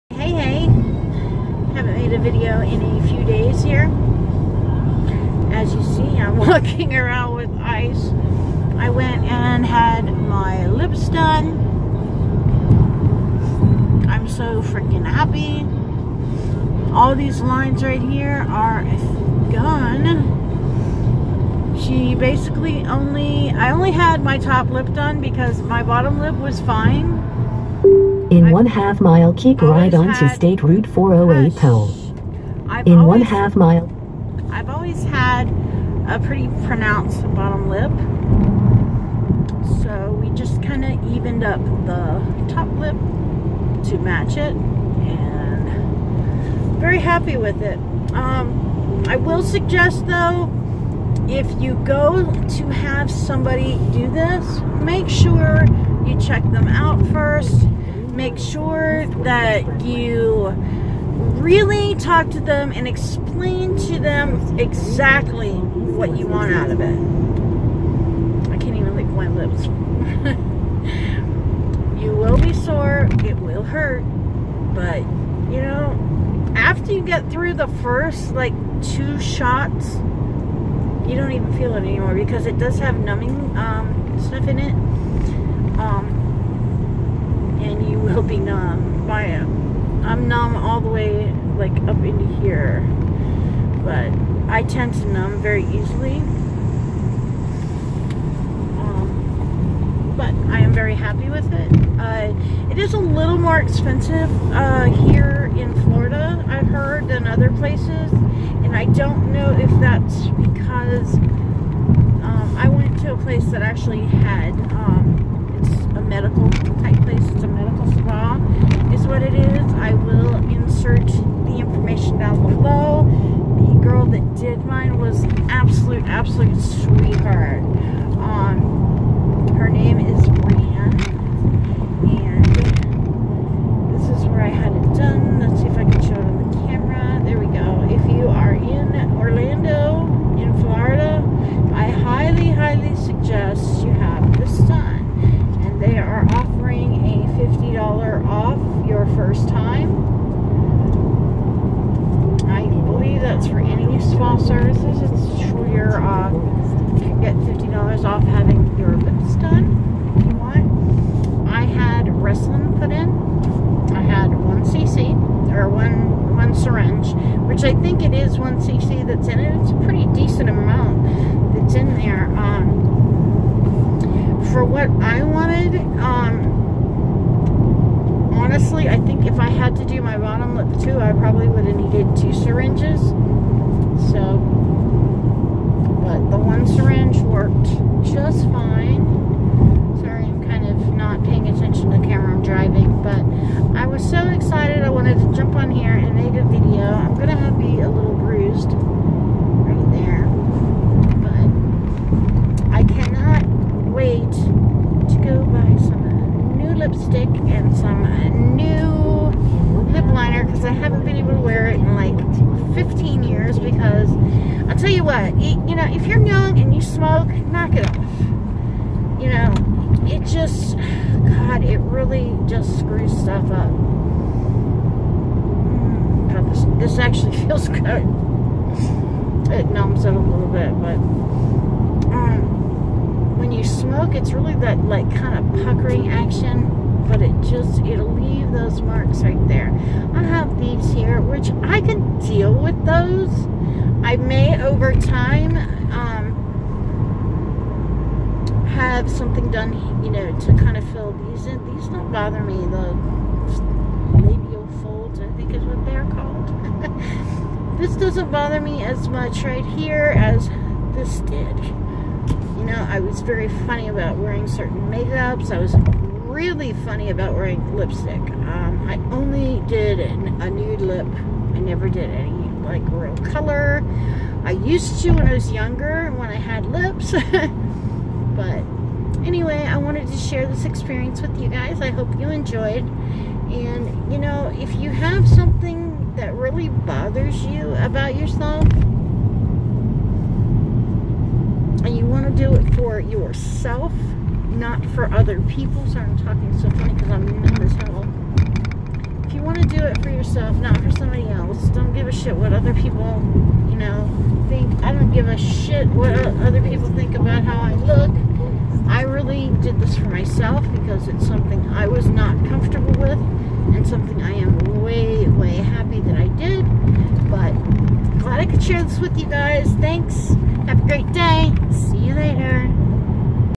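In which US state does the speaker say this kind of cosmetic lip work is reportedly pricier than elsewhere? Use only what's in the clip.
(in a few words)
Florida.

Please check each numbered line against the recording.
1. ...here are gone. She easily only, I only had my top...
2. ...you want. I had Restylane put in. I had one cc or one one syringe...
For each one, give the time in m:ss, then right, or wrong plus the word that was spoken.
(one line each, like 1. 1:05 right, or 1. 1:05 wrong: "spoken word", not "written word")
1. 0:18 wrong: "basically", not "easily"
2. 2:40 right.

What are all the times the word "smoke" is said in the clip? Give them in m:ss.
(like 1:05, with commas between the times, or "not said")
3:36, 3:53.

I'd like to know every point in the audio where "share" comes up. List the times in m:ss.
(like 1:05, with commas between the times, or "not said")
4:40, 5:18.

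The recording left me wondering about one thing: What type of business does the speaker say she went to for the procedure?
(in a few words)
medical spa.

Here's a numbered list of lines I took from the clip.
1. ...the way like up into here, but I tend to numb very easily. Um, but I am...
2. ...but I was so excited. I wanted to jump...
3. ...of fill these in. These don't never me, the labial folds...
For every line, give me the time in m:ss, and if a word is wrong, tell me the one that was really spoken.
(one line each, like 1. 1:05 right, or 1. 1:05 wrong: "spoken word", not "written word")
1. 1:30 right
2. 3:13 right
3. 4:10 wrong: "bother", not "never".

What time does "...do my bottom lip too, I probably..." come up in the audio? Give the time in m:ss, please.
2:59.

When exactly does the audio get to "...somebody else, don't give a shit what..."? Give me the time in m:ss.
5:00.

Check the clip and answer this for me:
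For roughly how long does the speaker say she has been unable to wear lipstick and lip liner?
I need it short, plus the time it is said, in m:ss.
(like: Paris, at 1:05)
15 years, at 3:32.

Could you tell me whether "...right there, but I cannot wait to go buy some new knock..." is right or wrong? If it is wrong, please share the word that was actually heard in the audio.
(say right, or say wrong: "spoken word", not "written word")
wrong: "lipstick", not "knock".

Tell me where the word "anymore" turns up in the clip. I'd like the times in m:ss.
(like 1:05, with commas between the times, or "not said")
1:21.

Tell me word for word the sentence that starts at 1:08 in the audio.
I can't even lick my lips.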